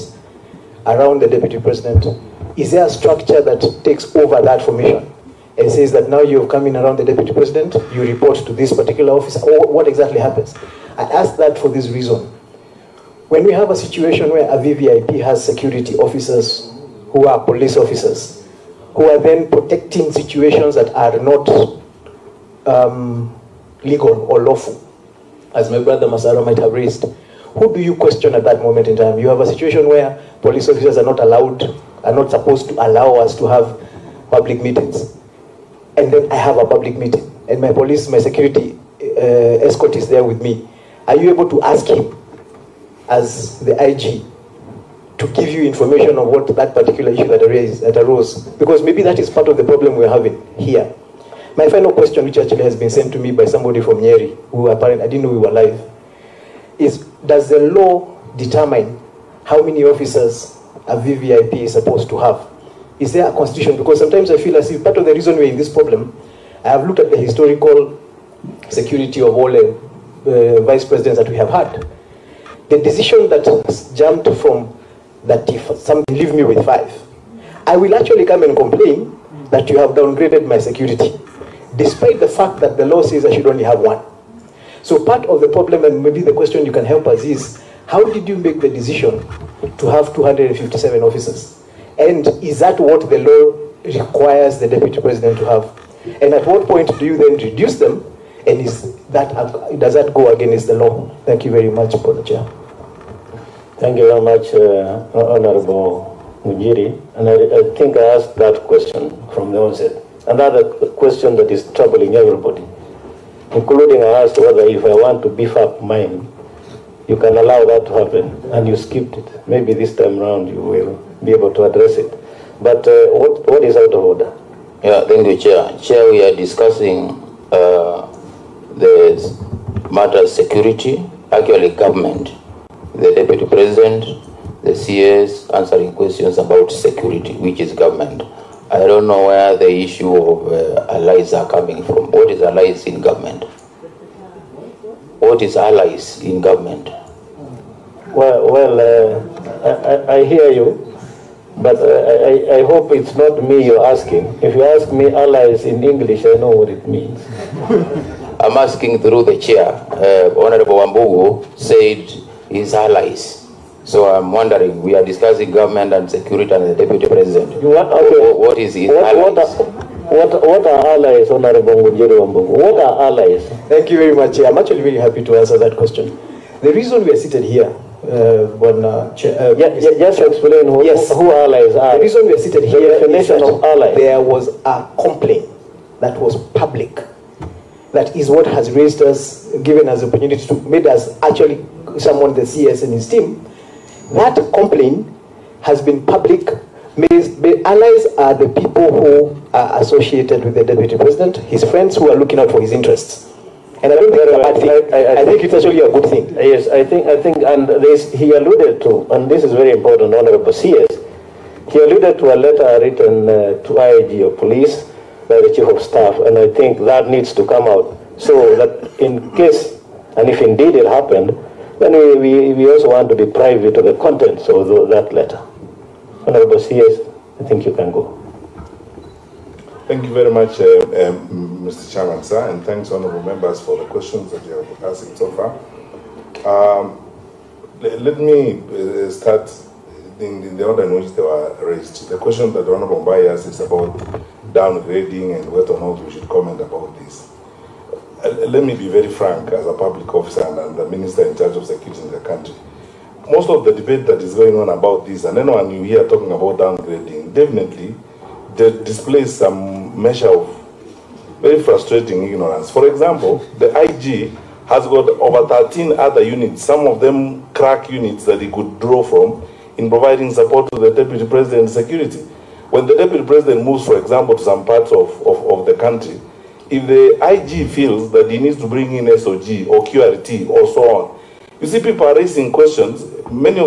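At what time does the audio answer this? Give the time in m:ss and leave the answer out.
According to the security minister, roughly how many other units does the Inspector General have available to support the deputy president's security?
4:25.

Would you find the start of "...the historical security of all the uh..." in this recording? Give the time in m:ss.
1:07.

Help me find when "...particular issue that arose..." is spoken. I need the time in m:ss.
0:46.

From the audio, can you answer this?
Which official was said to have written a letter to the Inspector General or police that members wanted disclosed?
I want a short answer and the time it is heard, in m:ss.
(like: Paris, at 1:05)
Chief of staff, at 3:35.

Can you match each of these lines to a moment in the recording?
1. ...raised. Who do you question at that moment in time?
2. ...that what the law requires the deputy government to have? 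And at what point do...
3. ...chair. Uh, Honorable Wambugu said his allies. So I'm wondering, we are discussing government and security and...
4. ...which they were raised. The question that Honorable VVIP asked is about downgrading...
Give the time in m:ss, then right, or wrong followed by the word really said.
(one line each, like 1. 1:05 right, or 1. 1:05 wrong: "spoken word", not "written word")
1. 0:26 right
2. 1:32 wrong: "president", not "government"
3. 2:39 right
4. 4:01 wrong: "Mbai", not "VVIP".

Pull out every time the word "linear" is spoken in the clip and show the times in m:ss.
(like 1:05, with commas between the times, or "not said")
not said.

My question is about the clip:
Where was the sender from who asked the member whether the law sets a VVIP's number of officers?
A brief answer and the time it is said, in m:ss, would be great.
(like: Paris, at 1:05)
Nyeri, at 0:53.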